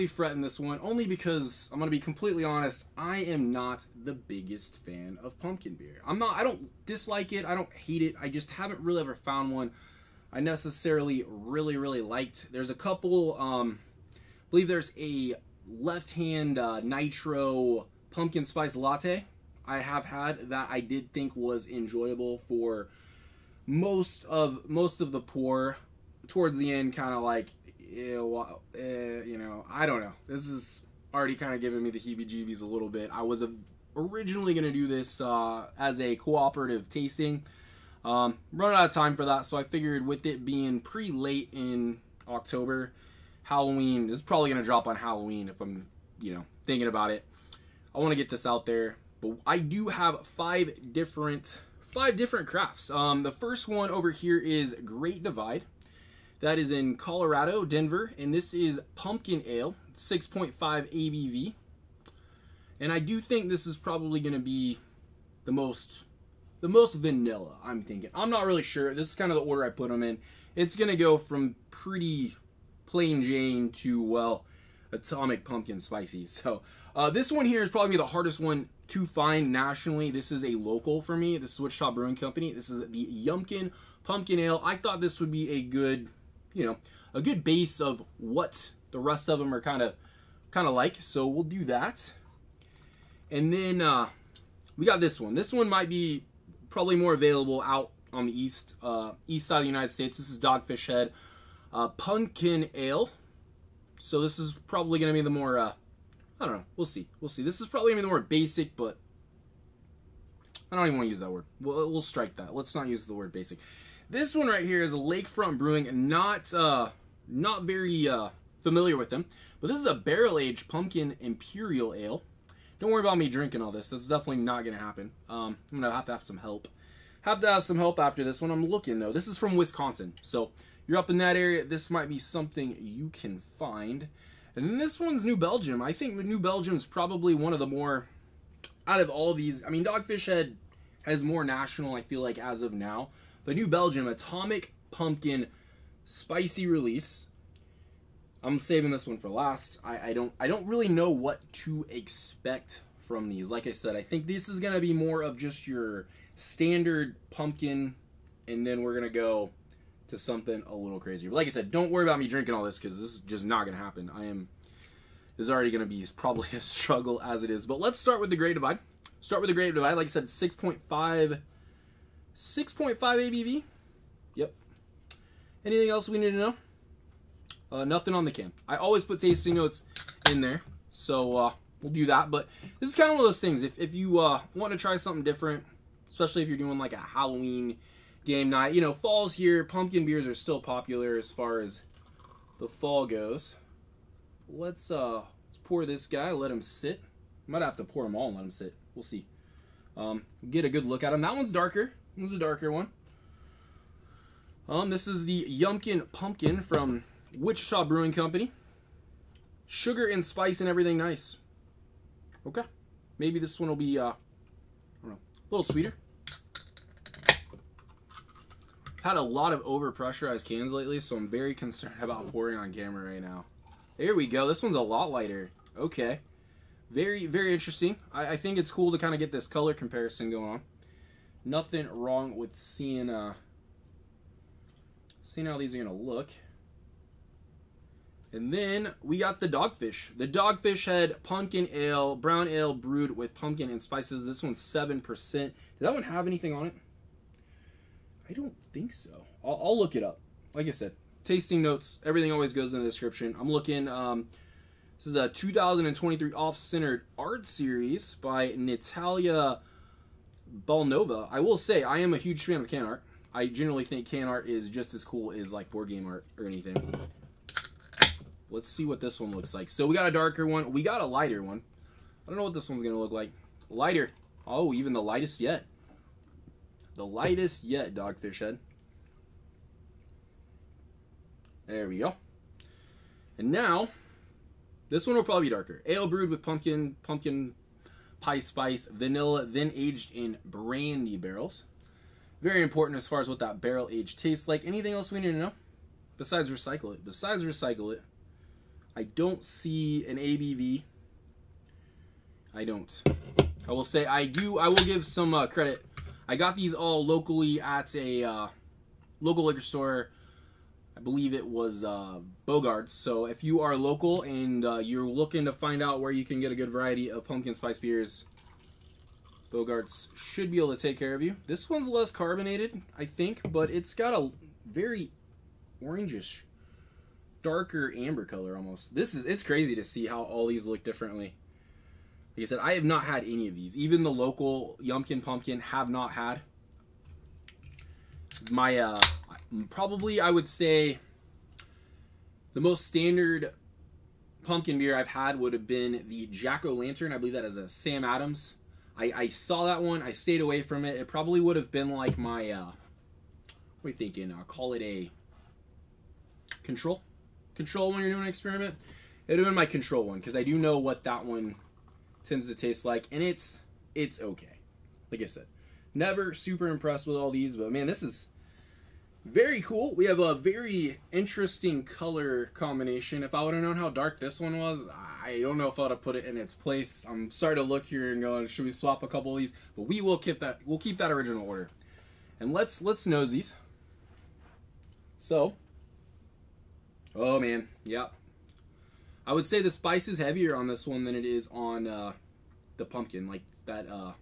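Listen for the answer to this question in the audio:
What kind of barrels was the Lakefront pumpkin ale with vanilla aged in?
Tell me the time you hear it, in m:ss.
4:50.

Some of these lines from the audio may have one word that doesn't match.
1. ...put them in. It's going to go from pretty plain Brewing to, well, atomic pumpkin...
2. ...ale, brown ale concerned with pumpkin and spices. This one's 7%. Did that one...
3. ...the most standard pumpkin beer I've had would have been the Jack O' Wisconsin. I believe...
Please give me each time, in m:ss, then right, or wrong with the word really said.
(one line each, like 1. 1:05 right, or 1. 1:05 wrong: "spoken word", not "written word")
1. 1:09 wrong: "Jane", not "Brewing"
2. 4:01 wrong: "brewed", not "concerned"
3. 5:42 wrong: "Lantern", not "Wisconsin".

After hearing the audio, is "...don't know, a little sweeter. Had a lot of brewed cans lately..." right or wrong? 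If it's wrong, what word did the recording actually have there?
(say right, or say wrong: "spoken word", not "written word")
wrong: "overpressurized", not "brewed".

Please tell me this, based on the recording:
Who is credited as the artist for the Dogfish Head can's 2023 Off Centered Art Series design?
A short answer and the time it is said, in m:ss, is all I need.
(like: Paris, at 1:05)
Natalia Nova, at 4:18.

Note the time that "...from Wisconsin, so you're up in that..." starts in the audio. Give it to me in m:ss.
2:09.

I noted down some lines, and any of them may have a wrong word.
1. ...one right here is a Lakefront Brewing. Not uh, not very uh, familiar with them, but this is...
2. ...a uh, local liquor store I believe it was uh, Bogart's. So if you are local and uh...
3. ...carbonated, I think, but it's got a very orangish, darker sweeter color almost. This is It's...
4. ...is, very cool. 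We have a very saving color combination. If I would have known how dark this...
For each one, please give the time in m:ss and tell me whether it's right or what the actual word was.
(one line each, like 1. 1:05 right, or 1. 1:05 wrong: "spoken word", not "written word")
1. 1:54 right
2. 5:07 right
3. 5:22 wrong: "amber", not "sweeter"
4. 6:08 wrong: "interesting", not "saving".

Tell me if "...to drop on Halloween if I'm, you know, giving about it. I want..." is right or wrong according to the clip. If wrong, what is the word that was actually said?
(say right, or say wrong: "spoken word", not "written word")
wrong: "thinking", not "giving".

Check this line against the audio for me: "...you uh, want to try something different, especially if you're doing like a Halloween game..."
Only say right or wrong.
right.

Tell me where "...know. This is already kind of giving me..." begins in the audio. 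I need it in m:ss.
0:30.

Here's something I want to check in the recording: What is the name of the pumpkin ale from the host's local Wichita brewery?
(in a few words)
Yumkin Pumpkin Ale.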